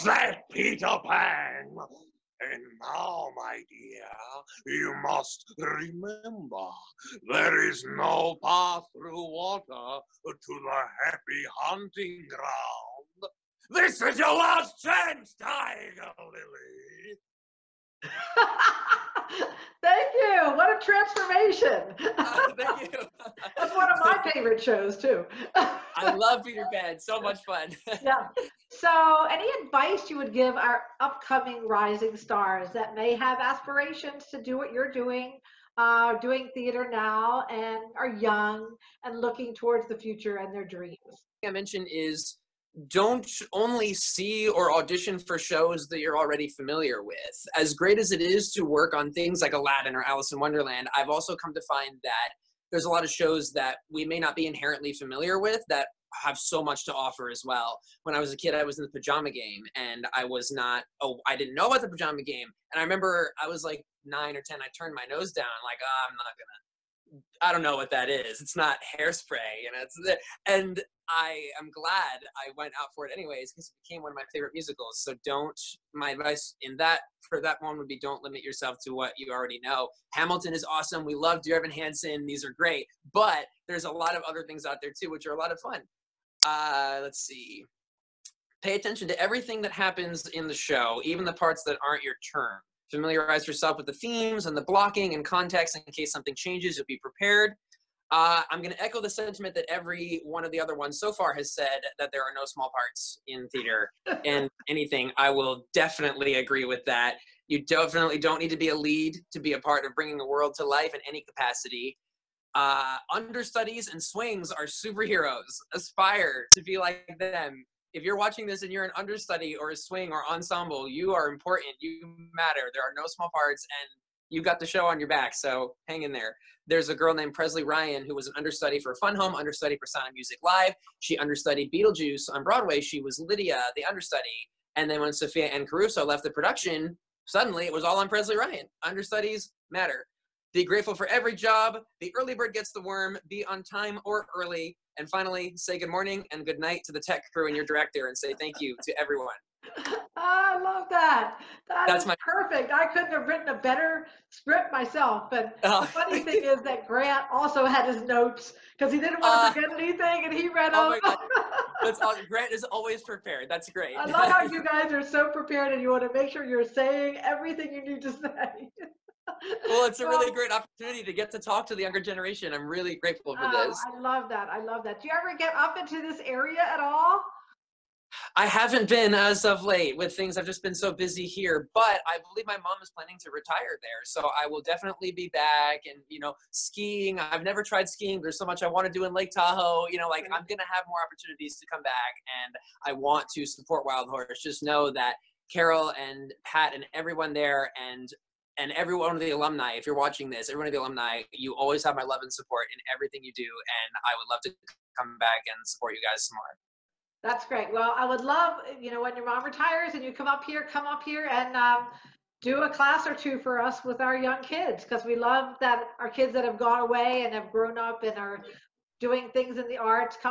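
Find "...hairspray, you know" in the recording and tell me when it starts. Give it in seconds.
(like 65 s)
68 s.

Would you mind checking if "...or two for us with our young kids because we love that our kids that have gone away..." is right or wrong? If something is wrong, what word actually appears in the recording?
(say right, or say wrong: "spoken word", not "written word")
right.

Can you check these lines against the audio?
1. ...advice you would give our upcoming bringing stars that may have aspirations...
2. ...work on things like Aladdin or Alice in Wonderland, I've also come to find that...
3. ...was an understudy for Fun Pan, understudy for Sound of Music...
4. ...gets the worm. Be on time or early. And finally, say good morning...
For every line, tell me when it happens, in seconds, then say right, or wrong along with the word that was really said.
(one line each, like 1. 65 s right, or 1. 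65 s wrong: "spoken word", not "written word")
1. 29 s wrong: "rising", not "bringing"
2. 48 s right
3. 128 s wrong: "Home", not "Pan"
4. 142 s right.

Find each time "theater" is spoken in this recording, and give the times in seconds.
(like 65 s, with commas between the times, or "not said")
36 s, 103 s.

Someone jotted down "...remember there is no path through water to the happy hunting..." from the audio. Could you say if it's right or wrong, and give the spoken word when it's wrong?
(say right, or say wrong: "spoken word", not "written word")
right.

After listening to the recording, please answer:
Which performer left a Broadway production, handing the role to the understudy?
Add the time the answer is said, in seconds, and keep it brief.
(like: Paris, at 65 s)
Sophia Anne Caruso, at 135 s.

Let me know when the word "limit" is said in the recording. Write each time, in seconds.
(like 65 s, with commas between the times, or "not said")
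78 s.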